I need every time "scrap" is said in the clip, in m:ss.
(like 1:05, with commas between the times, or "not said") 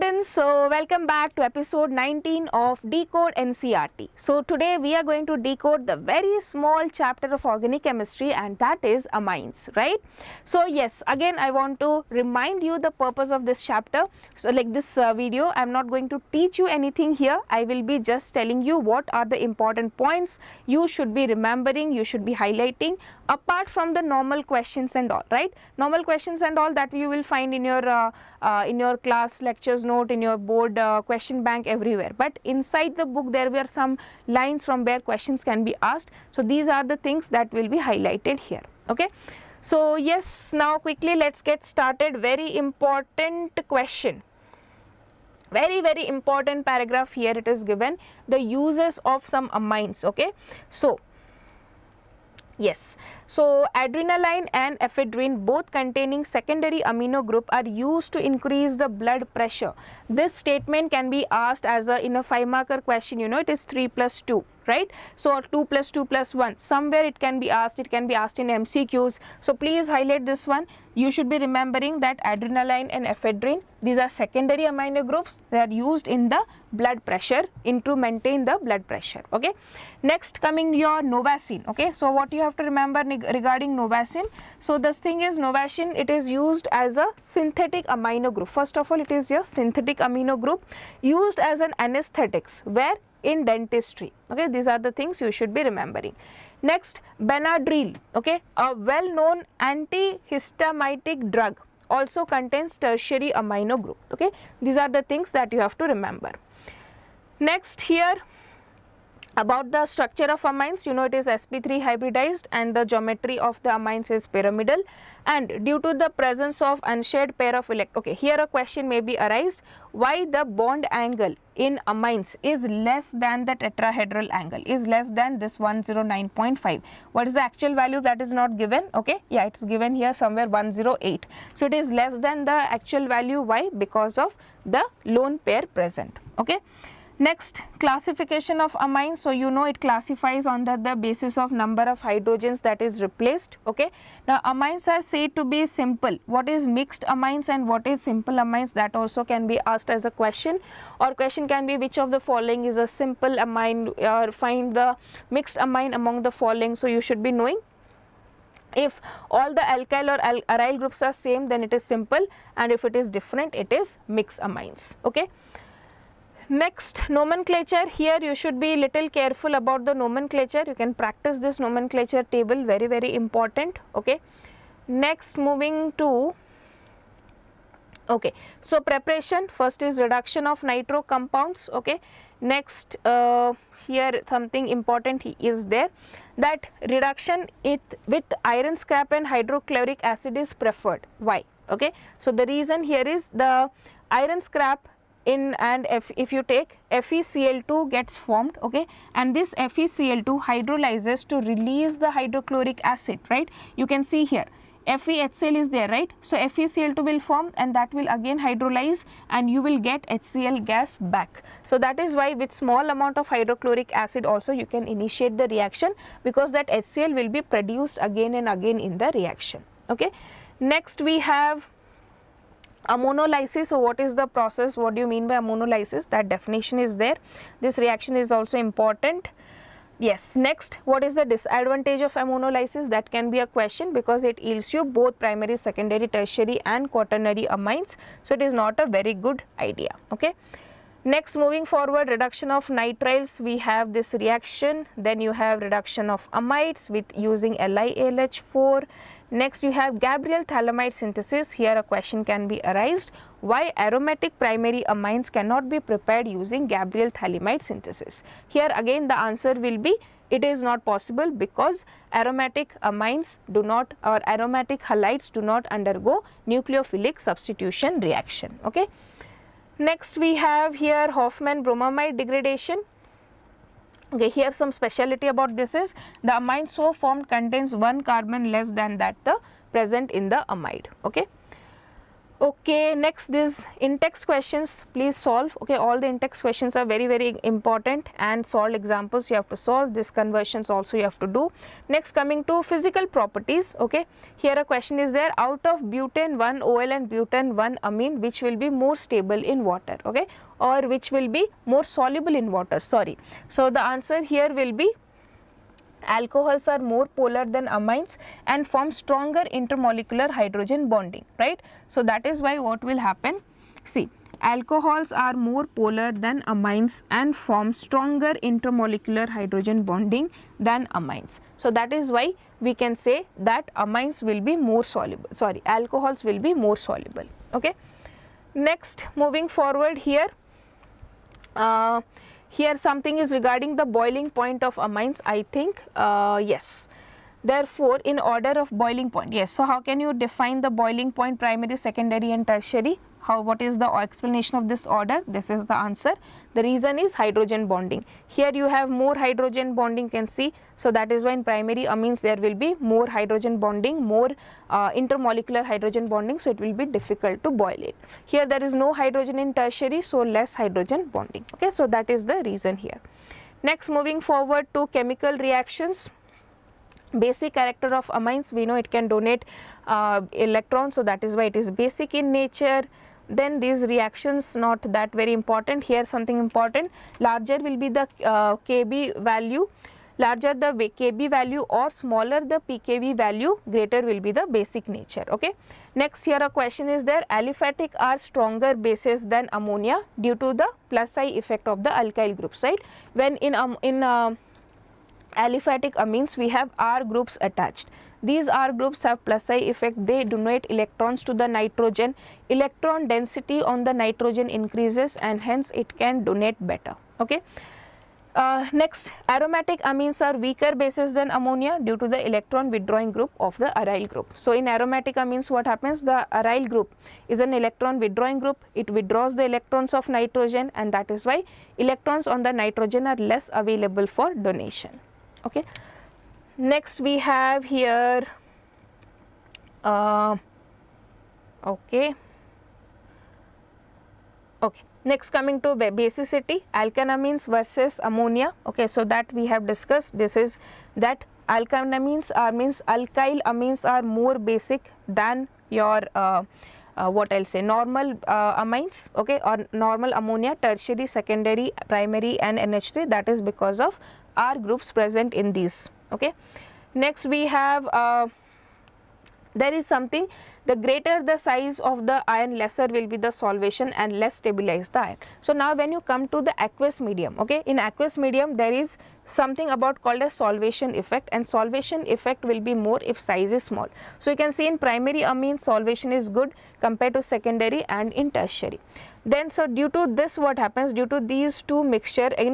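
3:08, 3:14.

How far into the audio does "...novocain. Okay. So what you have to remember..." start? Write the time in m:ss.
1:21.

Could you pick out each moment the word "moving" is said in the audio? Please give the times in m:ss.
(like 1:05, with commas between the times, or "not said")
2:55, 4:01, 5:29, 6:03.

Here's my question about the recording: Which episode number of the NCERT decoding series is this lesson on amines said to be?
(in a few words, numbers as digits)
19.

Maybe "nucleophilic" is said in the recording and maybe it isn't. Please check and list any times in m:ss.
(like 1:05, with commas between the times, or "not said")
4:26.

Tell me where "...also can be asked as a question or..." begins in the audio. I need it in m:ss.
2:28.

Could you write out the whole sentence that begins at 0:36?
So these are the things that will be highlighted here.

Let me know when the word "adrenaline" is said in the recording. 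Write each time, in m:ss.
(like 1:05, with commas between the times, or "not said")
0:53, 1:12.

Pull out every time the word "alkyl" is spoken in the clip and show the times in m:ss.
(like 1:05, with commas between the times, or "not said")
2:39, 6:31, 7:22.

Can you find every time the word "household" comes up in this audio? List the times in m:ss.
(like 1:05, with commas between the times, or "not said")
not said.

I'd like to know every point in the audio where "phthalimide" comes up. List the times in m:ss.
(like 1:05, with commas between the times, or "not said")
4:10, 4:17.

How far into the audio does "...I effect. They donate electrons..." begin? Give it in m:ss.
6:39.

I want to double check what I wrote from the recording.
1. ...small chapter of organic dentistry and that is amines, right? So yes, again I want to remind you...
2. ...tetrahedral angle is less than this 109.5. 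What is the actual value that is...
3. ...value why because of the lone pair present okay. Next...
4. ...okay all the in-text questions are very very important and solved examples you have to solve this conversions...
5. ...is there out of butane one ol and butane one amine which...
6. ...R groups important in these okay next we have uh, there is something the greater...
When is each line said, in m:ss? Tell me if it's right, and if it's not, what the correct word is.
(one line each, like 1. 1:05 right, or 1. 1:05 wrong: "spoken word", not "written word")
1. 0:06 wrong: "chemistry", not "dentistry"
2. 2:03 right
3. 2:13 right
4. 4:45 right
5. 4:54 right
6. 7:34 wrong: "present", not "important".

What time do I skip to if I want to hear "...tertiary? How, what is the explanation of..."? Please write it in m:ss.
5:42.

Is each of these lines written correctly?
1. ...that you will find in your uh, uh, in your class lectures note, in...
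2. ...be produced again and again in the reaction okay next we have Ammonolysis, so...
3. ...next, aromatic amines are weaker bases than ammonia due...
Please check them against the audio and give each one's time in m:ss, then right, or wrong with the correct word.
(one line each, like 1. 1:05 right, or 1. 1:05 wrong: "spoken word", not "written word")
1. 0:26 right
2. 3:37 right
3. 6:48 right.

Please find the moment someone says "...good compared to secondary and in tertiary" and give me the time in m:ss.
7:56.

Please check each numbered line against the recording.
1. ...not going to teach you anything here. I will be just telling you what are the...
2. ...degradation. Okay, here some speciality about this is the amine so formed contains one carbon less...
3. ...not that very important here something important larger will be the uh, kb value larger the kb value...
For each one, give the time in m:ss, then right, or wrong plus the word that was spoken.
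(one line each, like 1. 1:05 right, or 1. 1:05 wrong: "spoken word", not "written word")
1. 0:15 right
2. 4:32 right
3. 6:14 right.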